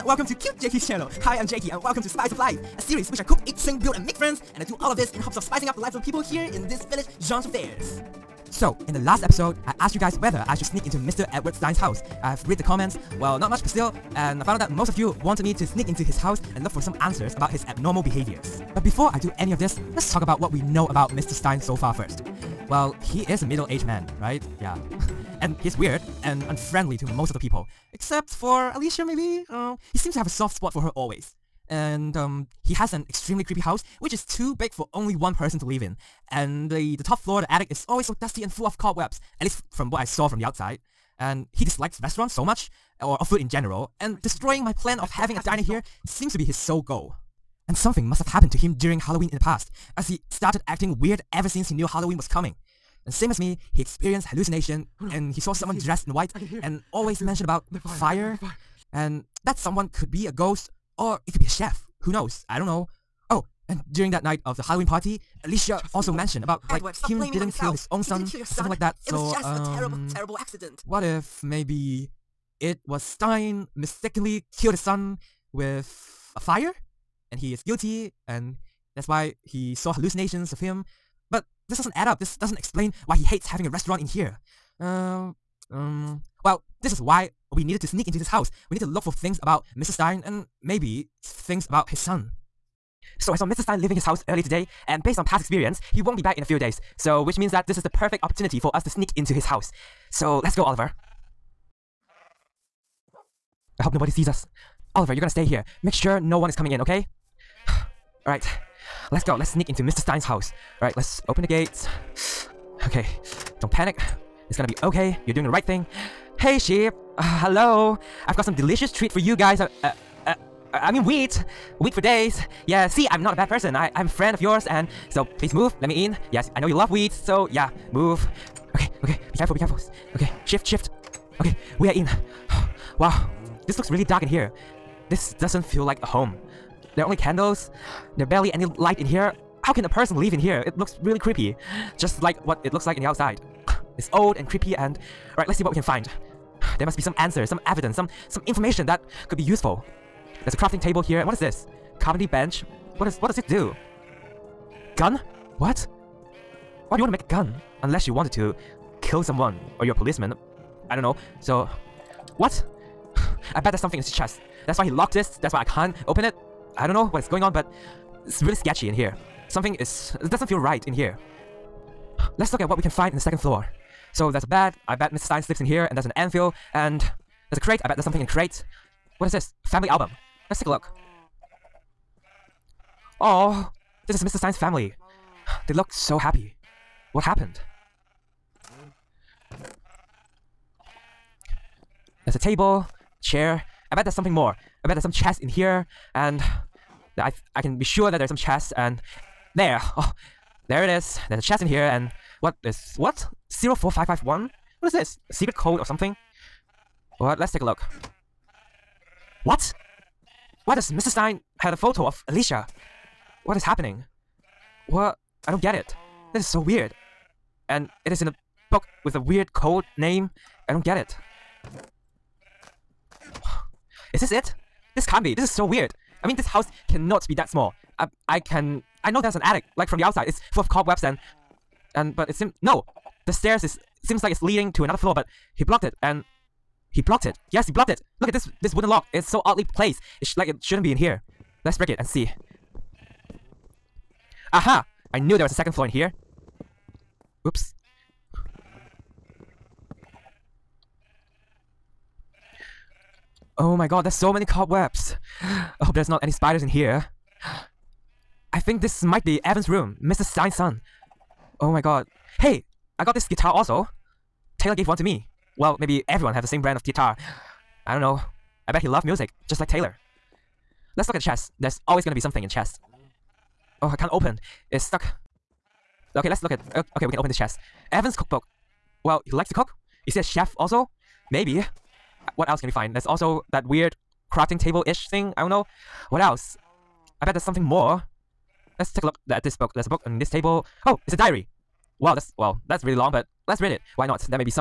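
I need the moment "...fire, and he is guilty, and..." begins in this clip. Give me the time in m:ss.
1:16.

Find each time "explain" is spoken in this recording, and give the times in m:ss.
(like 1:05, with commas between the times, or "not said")
1:22.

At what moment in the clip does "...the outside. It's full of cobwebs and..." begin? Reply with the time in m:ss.
3:49.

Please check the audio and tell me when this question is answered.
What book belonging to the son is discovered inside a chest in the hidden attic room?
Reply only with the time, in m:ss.
4:37.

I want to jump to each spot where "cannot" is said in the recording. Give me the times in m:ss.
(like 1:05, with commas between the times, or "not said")
3:46.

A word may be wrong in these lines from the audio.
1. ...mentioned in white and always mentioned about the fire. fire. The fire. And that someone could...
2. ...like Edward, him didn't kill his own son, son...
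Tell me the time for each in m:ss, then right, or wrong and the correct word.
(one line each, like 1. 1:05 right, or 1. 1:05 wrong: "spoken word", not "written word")
1. 0:55 wrong: "dressed", not "mentioned"
2. 1:06 right.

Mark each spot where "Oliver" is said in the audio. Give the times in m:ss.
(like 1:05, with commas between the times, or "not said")
1:40, 1:44.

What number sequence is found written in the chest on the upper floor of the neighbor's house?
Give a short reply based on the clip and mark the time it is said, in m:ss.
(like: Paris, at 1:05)
04551, at 3:23.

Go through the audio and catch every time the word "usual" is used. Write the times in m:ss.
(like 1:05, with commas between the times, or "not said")
not said.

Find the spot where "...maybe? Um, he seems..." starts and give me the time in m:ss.
0:29.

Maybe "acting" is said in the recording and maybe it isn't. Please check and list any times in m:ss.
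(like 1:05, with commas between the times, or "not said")
0:50.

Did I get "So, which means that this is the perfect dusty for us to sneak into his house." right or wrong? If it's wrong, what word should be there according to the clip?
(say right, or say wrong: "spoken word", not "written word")
wrong: "opportunity", not "dusty".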